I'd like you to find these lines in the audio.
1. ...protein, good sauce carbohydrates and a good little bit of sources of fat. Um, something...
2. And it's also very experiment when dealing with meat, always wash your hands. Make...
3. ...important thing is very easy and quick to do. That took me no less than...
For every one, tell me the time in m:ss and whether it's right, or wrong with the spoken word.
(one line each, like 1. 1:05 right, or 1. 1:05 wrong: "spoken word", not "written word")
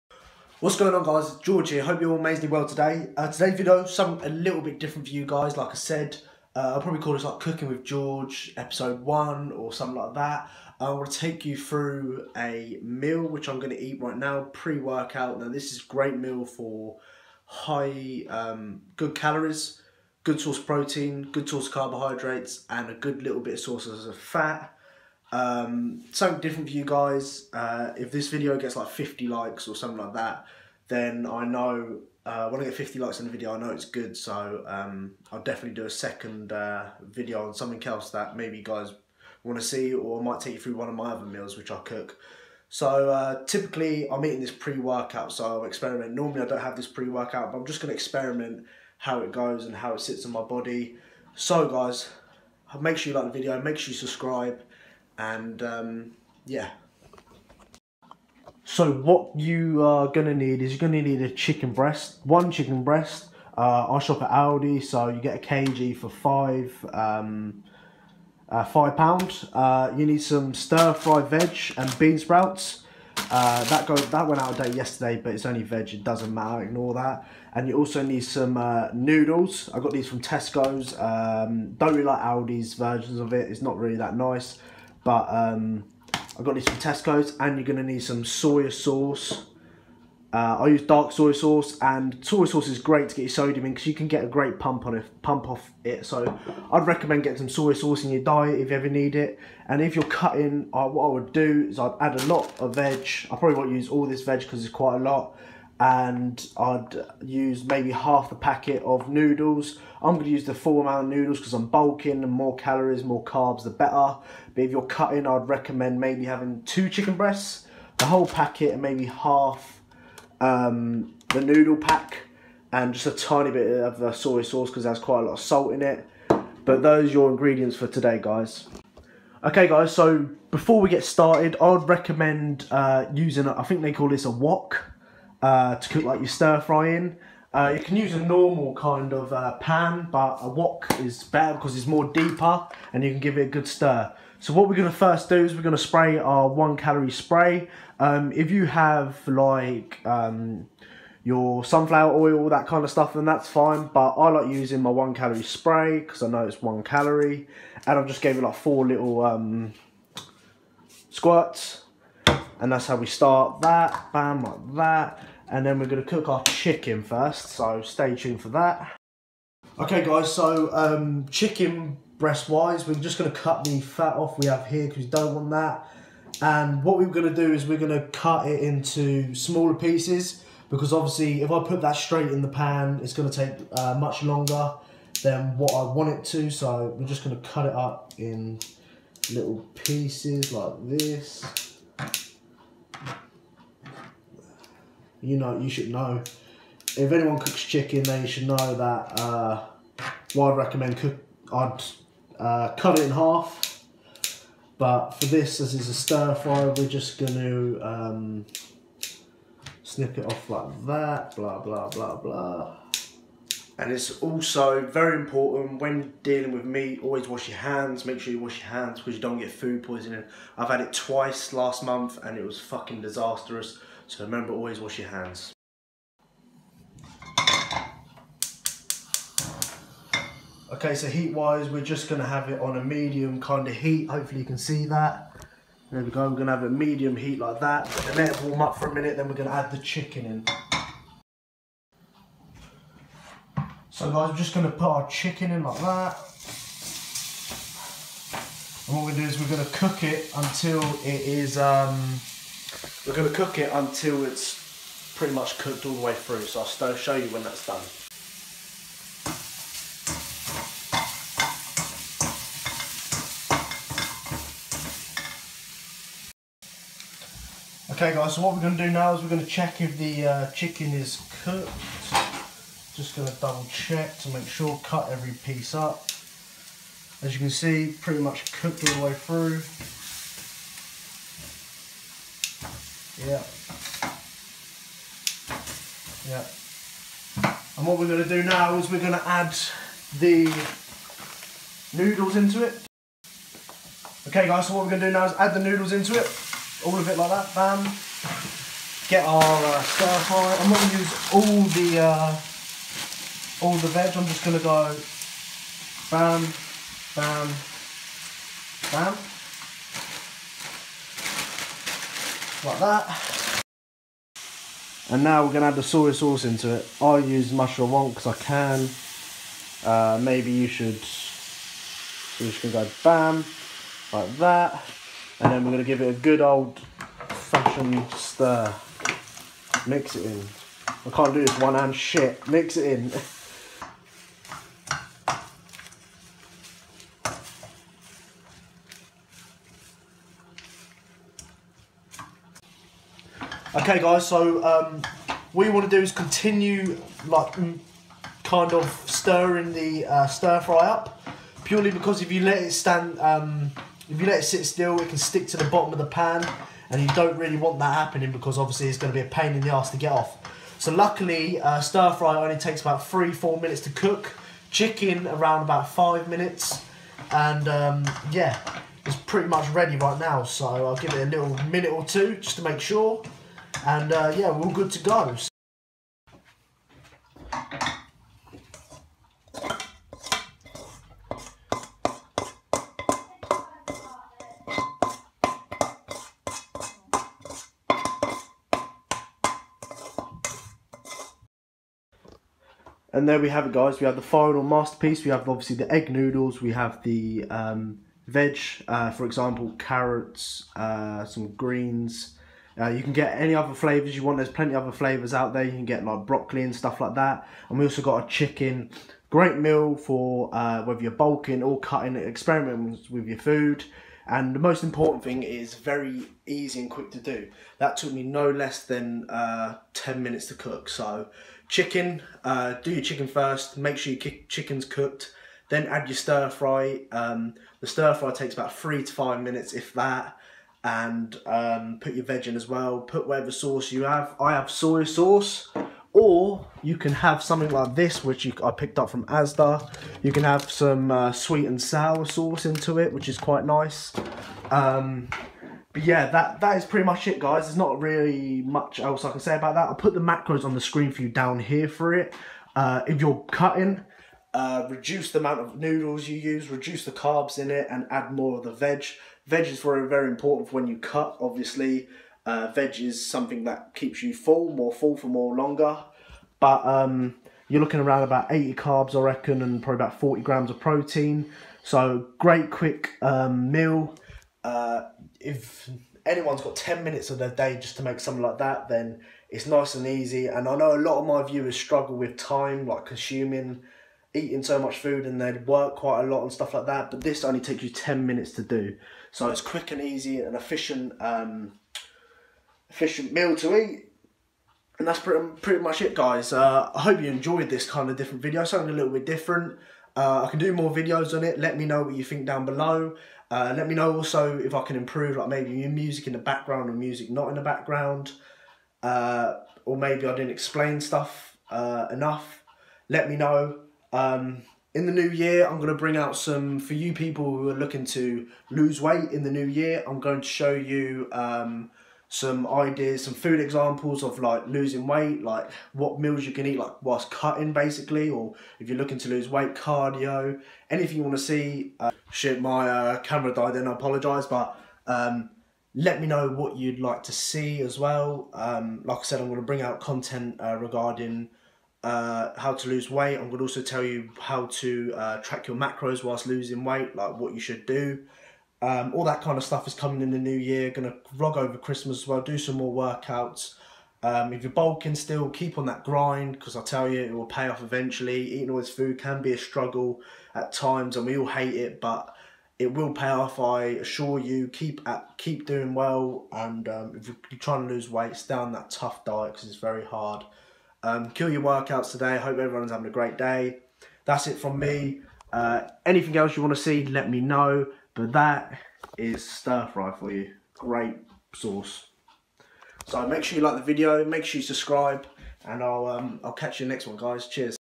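1. 0:20 wrong: "source", not "sauce"
2. 3:33 wrong: "important", not "experiment"
3. 6:54 right.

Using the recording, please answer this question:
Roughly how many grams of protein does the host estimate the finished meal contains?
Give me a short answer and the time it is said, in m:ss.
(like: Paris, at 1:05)
40 grams, at 7:50.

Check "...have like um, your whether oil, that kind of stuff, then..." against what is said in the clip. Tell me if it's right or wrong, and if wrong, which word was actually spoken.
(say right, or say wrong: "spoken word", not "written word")
wrong: "sunflower", not "whether".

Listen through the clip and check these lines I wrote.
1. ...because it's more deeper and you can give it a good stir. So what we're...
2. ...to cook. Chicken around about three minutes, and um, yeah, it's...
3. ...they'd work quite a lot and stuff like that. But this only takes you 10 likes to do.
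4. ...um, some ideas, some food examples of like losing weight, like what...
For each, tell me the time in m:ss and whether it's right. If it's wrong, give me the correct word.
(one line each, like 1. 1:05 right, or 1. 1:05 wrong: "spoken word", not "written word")
1. 2:21 right
2. 6:03 wrong: "five", not "three"
3. 8:05 wrong: "minutes", not "likes"
4. 8:41 right.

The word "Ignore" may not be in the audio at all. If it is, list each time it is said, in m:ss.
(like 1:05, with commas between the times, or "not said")
1:16.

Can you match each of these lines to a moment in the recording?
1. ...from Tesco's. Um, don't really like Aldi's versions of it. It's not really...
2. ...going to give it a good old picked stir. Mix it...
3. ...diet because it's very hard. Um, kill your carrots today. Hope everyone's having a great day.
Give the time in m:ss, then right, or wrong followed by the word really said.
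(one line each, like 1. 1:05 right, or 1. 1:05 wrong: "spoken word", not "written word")
1. 1:20 right
2. 5:25 wrong: "fashioned", not "picked"
3. 9:29 wrong: "workouts", not "carrots".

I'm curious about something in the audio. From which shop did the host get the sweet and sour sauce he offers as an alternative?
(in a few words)
Asda.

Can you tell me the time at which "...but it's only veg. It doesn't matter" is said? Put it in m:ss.
1:15.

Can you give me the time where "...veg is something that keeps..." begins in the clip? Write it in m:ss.
7:42.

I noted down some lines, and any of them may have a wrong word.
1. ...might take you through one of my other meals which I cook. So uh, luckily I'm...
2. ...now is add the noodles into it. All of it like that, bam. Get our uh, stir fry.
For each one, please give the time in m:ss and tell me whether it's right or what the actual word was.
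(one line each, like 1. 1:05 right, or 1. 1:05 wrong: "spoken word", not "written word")
1. 0:40 wrong: "typically", not "luckily"
2. 4:55 right.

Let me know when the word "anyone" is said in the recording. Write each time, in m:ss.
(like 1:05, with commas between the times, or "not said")
3:17, 7:56.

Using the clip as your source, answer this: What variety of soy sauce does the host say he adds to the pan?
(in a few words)
Mushroom.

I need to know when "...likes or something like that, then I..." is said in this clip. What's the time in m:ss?
0:29.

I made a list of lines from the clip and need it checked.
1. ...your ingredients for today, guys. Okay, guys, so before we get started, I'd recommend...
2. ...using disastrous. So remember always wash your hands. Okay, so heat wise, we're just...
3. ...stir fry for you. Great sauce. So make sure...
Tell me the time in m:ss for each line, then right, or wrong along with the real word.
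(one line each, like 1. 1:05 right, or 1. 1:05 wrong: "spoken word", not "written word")
1. 2:07 right
2. 3:42 wrong: "fucking", not "using"
3. 9:39 right.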